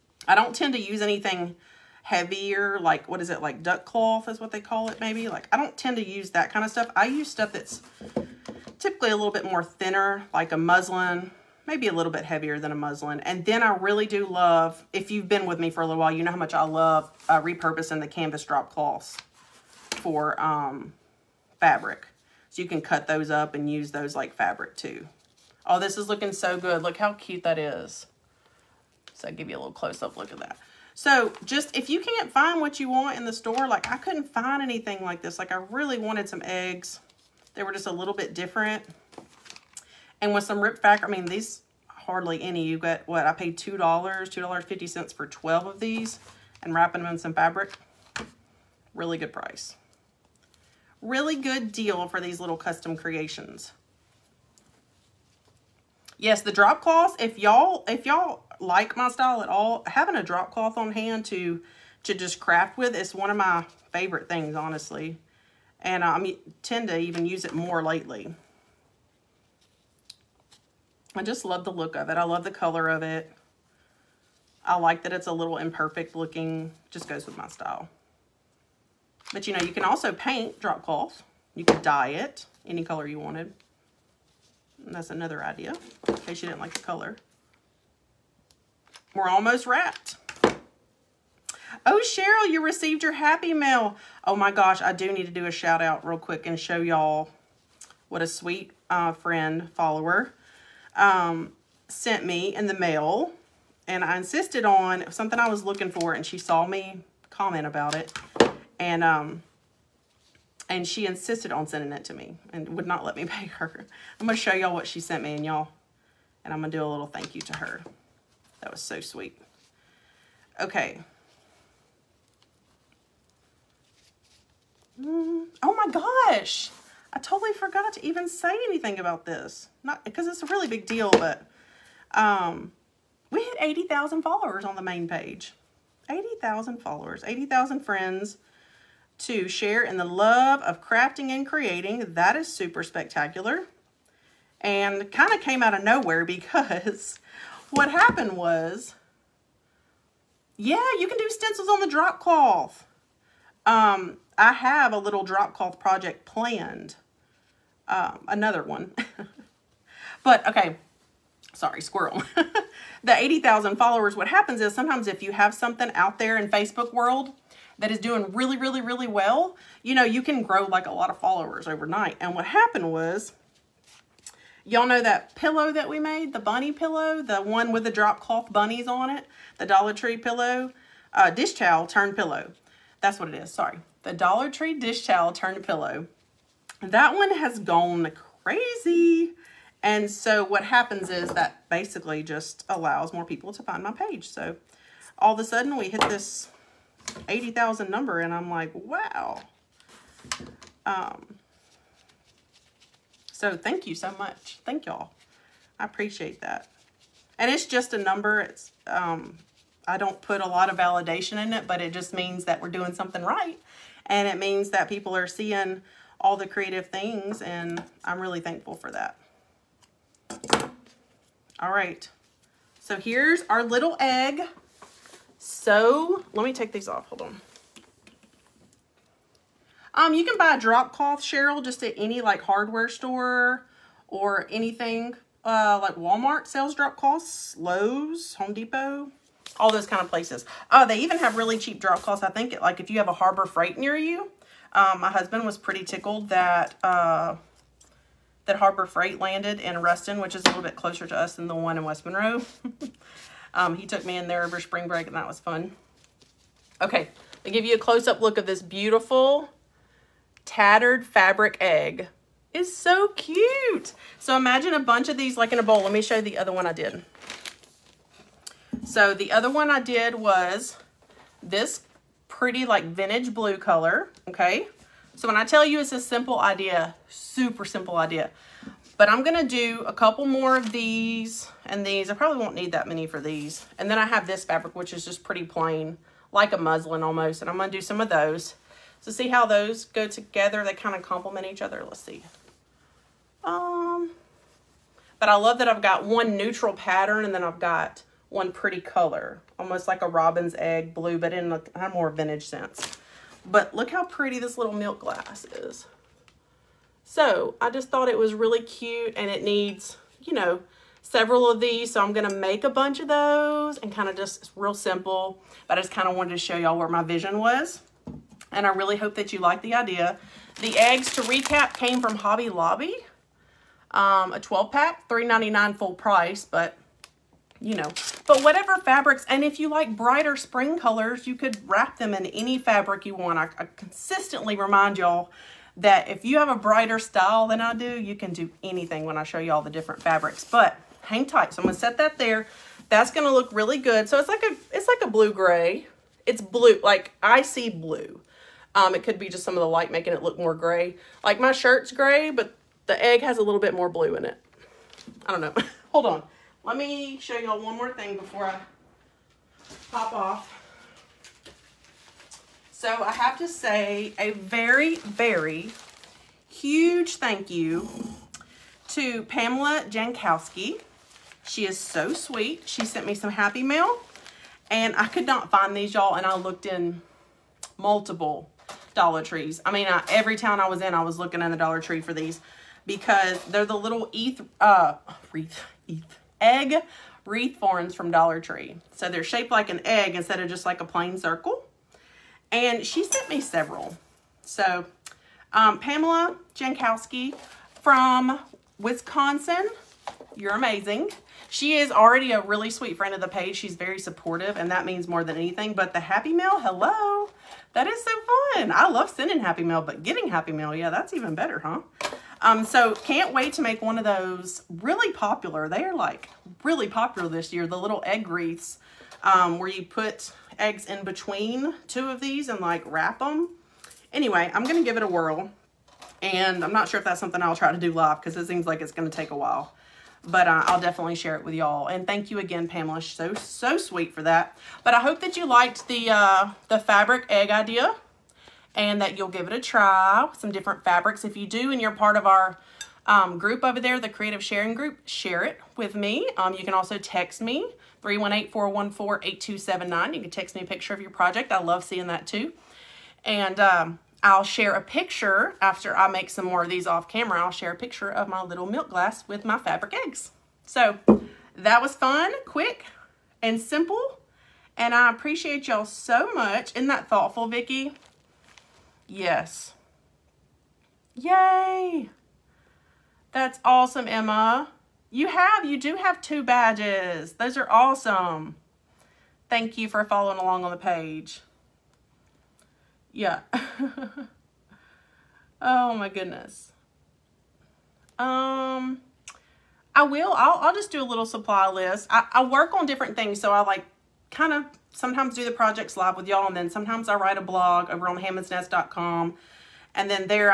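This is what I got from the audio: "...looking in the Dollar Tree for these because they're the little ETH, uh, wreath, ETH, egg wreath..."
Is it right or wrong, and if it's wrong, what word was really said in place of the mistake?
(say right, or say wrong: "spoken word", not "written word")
right.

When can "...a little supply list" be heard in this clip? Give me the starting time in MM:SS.
08:11.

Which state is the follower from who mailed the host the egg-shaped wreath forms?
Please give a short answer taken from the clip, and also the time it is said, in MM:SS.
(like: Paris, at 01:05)
Wisconsin, at 06:38.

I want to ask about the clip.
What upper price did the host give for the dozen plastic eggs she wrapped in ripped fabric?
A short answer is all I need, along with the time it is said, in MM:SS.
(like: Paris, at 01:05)
$2.50, at 00:43.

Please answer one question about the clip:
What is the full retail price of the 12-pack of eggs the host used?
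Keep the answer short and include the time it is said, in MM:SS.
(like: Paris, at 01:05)
$3.99, at 05:25.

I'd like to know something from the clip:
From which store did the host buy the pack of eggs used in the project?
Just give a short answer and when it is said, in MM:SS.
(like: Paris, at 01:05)
Hobby Lobby, at 05:22.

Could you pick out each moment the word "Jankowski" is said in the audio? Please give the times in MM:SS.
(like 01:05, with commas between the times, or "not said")
06:09, 06:36.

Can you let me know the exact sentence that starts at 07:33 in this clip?
And um, I'll share a picture after I make some more of these off camera.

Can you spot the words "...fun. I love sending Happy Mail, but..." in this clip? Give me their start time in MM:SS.
06:48.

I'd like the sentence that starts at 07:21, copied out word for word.
If you do and you're part of our um, group over there, the Creative Sharing Group, share it with me.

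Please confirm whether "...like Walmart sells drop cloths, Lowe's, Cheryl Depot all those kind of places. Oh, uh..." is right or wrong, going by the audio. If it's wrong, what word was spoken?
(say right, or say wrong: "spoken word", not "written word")
wrong: "Home", not "Cheryl".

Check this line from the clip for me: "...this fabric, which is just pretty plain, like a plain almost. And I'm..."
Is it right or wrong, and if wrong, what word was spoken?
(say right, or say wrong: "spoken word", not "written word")
wrong: "muslin", not "plain".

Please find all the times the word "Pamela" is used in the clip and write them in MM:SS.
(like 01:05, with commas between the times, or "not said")
06:09, 06:35, 07:12.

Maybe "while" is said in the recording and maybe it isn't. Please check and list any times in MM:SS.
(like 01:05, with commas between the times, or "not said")
00:16, 07:09.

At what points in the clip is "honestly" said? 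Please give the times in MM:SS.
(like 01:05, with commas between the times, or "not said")
01:04.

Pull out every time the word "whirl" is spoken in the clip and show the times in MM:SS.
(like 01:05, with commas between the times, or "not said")
07:05.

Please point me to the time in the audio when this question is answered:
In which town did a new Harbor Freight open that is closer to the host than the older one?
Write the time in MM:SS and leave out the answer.
04:09.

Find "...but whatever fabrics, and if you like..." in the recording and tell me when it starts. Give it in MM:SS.
05:28.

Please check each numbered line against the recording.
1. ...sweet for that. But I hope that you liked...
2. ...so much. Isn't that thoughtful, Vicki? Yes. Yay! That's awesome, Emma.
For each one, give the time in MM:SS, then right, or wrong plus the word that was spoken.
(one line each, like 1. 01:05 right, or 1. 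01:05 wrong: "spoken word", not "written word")
1. 07:13 right
2. 07:45 right.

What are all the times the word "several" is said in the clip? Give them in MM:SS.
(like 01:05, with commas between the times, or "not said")
05:11, 06:33.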